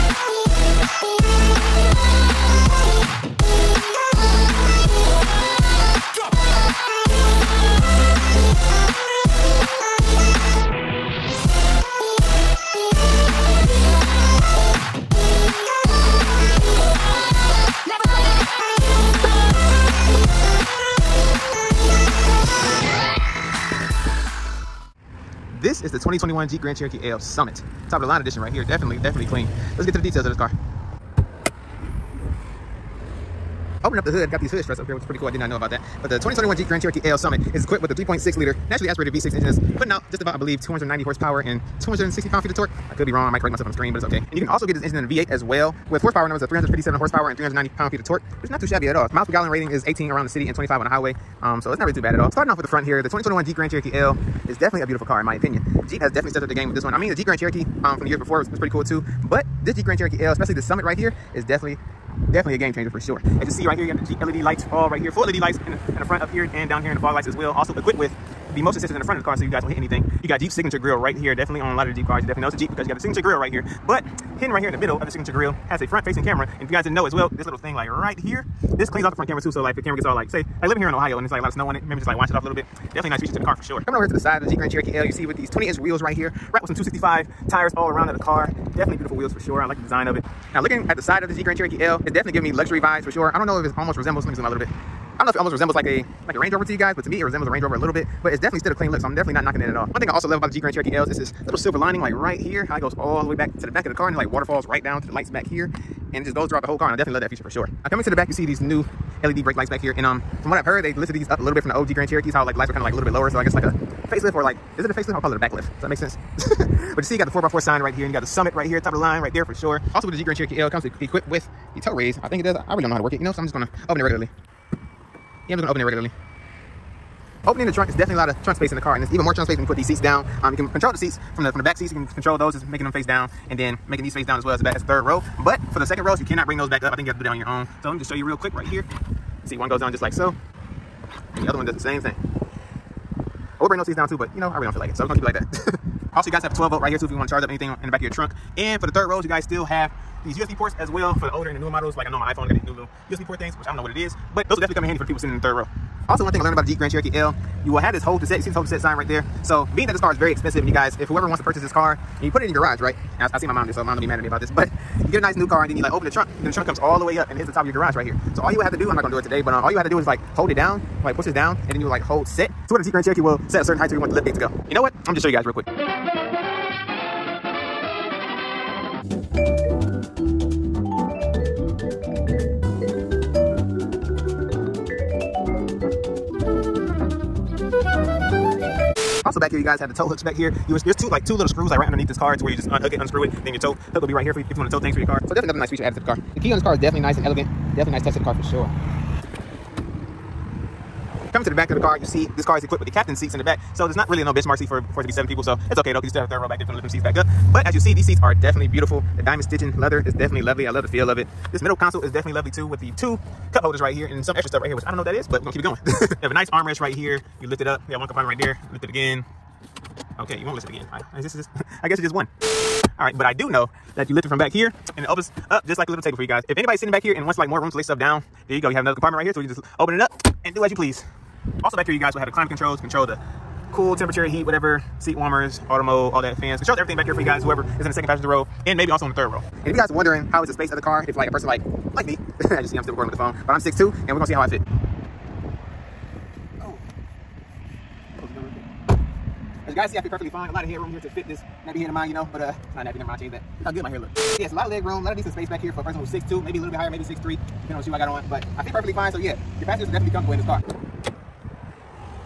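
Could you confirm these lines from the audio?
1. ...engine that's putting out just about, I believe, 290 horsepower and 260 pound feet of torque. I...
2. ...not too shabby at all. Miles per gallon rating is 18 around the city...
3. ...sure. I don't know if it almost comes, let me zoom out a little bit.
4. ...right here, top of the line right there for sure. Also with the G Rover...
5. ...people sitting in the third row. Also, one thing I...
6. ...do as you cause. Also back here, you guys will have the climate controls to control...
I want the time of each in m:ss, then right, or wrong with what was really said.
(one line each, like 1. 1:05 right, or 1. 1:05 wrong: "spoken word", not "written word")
1. 0:39 right
2. 0:48 right
3. 1:33 wrong: "resembles", not "comes"
4. 1:58 wrong: "Grand", not "Rover"
5. 2:35 right
6. 3:50 wrong: "please", not "cause".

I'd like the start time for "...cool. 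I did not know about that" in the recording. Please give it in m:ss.
0:35.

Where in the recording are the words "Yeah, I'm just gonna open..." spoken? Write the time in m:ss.
2:05.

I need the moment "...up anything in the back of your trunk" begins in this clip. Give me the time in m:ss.
2:27.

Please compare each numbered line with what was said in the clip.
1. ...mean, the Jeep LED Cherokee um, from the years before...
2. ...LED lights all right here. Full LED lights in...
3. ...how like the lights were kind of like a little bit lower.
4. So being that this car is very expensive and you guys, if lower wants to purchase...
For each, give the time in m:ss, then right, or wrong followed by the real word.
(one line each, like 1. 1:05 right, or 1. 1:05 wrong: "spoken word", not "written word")
1. 0:56 wrong: "Grand", not "LED"
2. 1:04 right
3. 1:52 right
4. 2:39 wrong: "whoever", not "lower".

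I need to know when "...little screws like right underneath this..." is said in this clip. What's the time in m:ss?
3:11.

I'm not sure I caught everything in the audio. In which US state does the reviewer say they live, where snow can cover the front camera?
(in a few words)
Ohio.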